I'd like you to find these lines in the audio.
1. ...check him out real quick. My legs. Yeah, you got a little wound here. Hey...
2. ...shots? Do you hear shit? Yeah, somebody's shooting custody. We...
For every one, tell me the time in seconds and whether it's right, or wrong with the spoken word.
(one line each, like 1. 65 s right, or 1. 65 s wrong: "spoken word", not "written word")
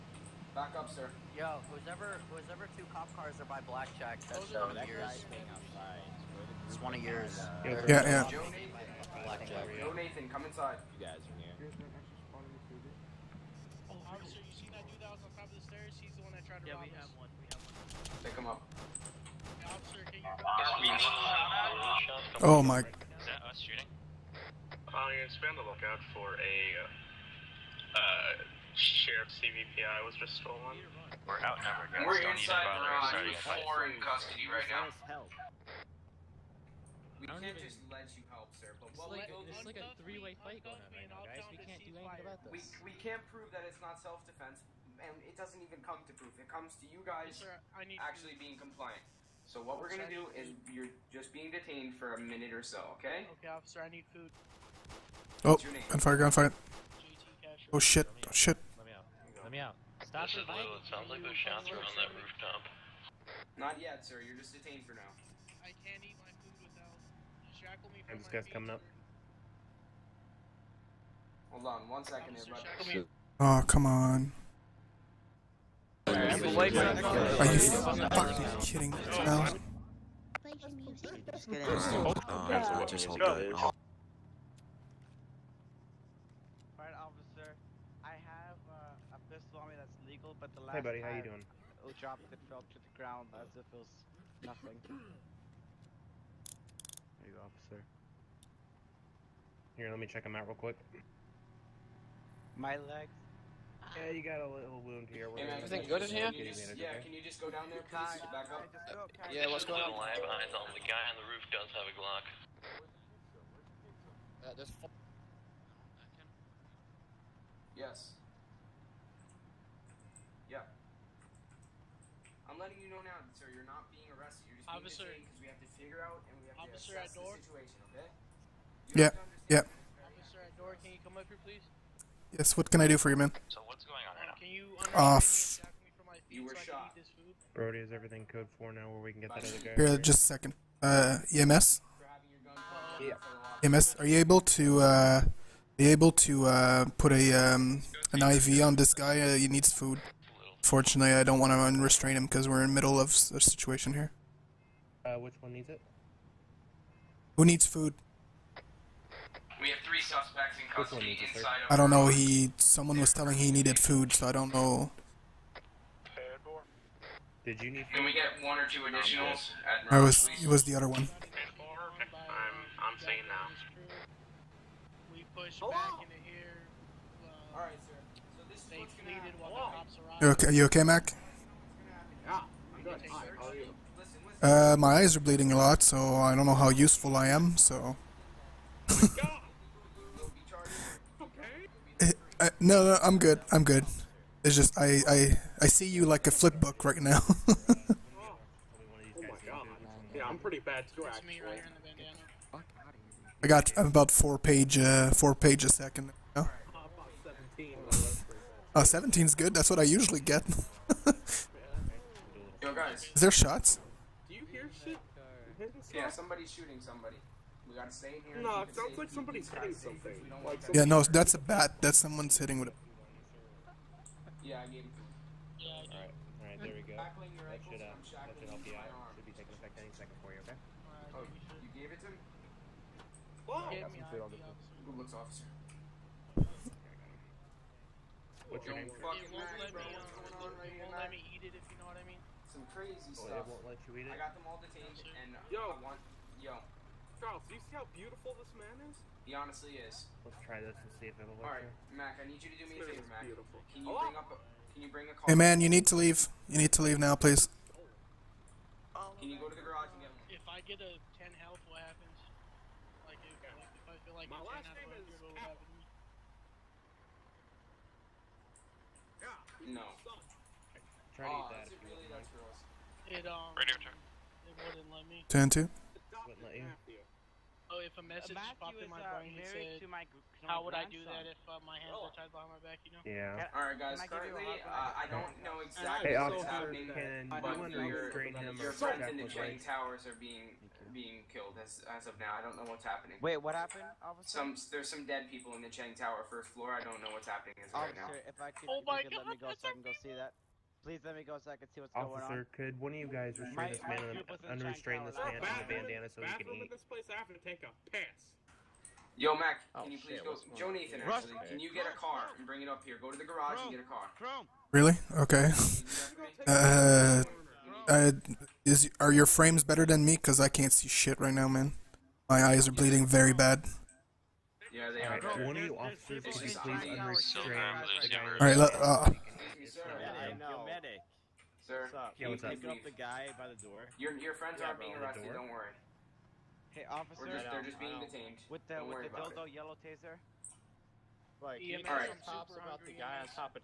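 1. 100 s right
2. 213 s wrong: "somebody", not "custody".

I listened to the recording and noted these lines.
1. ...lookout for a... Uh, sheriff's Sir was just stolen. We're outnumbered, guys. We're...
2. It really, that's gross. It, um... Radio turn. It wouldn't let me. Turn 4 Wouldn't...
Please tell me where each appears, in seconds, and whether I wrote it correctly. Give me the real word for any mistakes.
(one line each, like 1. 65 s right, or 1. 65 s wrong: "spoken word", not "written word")
1. 25 s wrong: "CVPI", not "Sir"
2. 271 s wrong: "2", not "4".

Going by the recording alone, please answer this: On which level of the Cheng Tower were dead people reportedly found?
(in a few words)
First floor.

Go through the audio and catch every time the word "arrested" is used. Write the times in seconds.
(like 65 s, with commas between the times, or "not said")
124 s, 334 s.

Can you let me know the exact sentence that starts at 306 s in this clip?
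this place, I have take a Yo, Mac, oh, can you please go?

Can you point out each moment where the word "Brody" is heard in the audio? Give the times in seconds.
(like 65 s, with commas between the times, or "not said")
137 s.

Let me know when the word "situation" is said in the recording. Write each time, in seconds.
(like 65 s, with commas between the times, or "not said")
127 s, 153 s.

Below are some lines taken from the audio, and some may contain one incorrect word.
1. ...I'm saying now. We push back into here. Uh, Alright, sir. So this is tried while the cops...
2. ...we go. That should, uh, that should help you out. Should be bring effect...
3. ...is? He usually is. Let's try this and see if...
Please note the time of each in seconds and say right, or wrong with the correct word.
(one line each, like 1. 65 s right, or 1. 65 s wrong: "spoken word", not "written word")
1. 172 s wrong: "fleeted", not "tried"
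2. 226 s wrong: "taking", not "bring"
3. 248 s wrong: "honestly", not "usually".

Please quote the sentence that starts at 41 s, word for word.
We can't do anything about this.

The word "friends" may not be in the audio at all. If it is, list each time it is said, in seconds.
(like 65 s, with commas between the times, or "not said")
288 s, 334 s.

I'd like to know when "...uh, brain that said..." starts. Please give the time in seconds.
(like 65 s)
279 s.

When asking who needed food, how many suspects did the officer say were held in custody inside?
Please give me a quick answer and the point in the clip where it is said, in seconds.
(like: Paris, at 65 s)
3, at 159 s.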